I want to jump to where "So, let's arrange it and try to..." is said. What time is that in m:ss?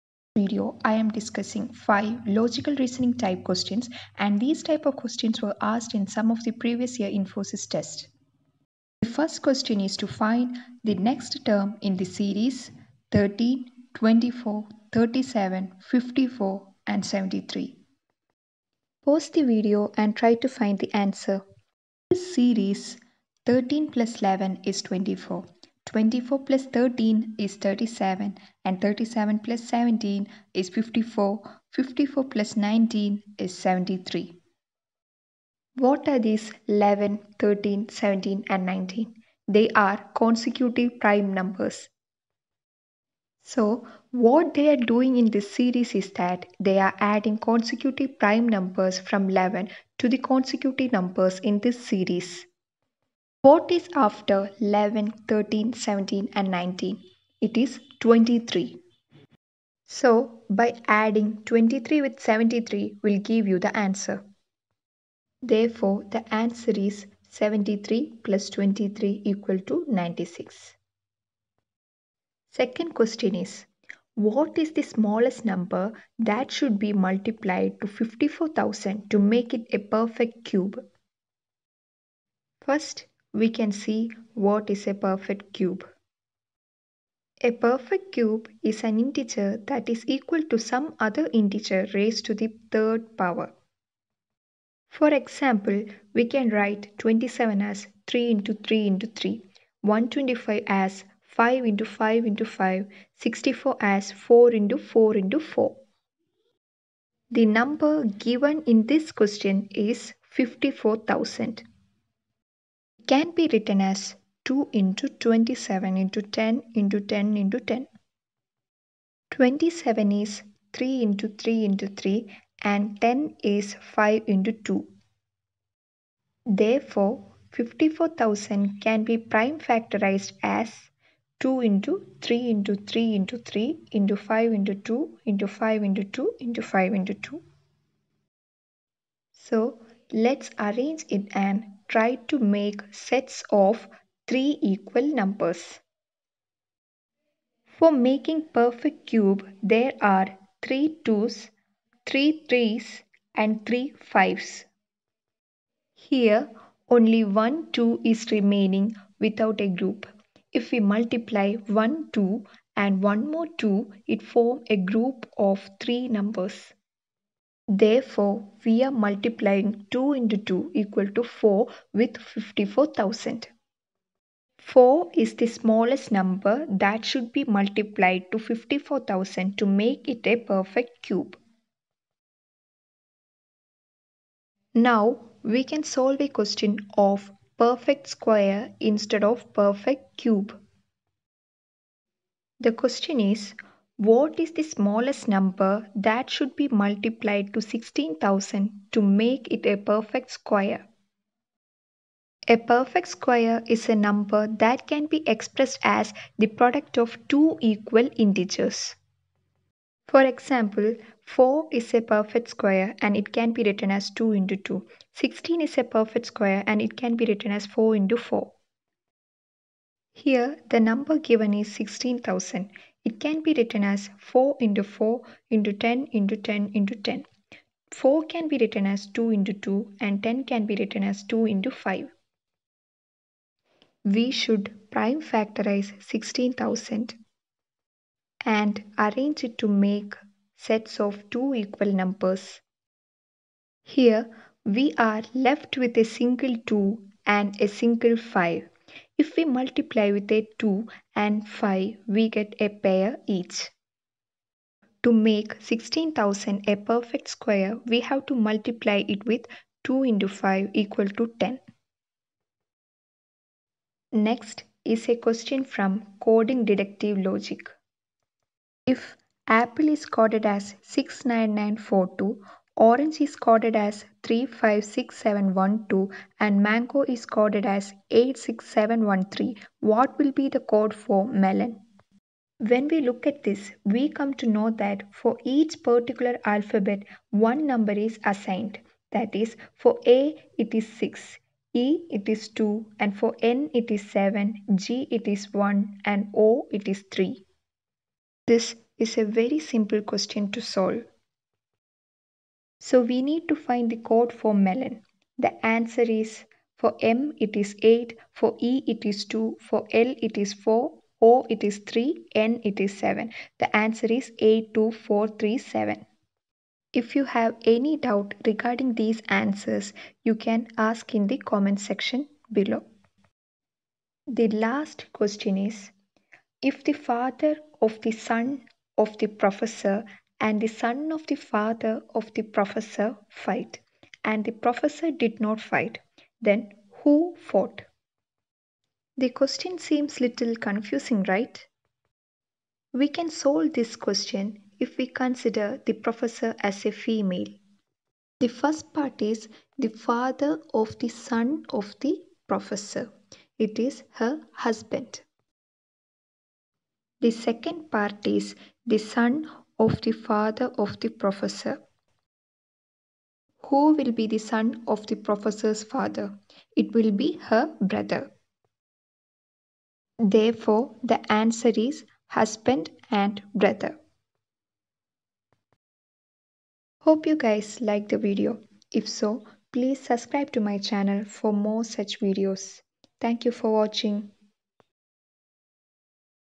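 2:19.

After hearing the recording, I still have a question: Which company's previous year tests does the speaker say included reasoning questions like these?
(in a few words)
Infosys.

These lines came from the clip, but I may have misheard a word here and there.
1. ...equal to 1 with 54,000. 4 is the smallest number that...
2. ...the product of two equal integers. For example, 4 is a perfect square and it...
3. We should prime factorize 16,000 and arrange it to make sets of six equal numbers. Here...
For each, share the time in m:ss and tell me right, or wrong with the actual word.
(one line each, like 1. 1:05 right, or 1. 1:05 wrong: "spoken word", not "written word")
1. 2:50 wrong: "4", not "1"
2. 3:26 right
3. 3:54 wrong: "two", not "six".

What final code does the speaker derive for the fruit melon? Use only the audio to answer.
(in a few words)
82437.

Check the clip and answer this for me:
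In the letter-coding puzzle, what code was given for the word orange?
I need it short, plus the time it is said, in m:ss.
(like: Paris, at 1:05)
356712, at 4:34.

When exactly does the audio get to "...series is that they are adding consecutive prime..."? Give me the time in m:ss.
0:45.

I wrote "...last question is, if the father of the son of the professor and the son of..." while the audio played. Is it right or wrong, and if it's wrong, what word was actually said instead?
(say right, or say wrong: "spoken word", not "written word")
right.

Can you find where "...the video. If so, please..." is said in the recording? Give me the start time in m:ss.
6:18.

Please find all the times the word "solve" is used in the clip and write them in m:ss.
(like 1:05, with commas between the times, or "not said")
3:05, 5:00, 5:43.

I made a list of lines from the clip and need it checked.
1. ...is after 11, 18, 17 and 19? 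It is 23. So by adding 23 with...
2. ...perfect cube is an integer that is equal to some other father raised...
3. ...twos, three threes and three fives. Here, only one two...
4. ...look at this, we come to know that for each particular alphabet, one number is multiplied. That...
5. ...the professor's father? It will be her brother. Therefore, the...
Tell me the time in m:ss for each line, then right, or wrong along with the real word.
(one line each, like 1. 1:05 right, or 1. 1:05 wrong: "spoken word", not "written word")
1. 0:53 wrong: "13", not "18"
2. 1:27 wrong: "integer", not "father"
3. 2:31 right
4. 4:43 wrong: "assigned", not "multiplied"
5. 6:05 right.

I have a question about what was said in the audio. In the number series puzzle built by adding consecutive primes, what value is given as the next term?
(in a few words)
96.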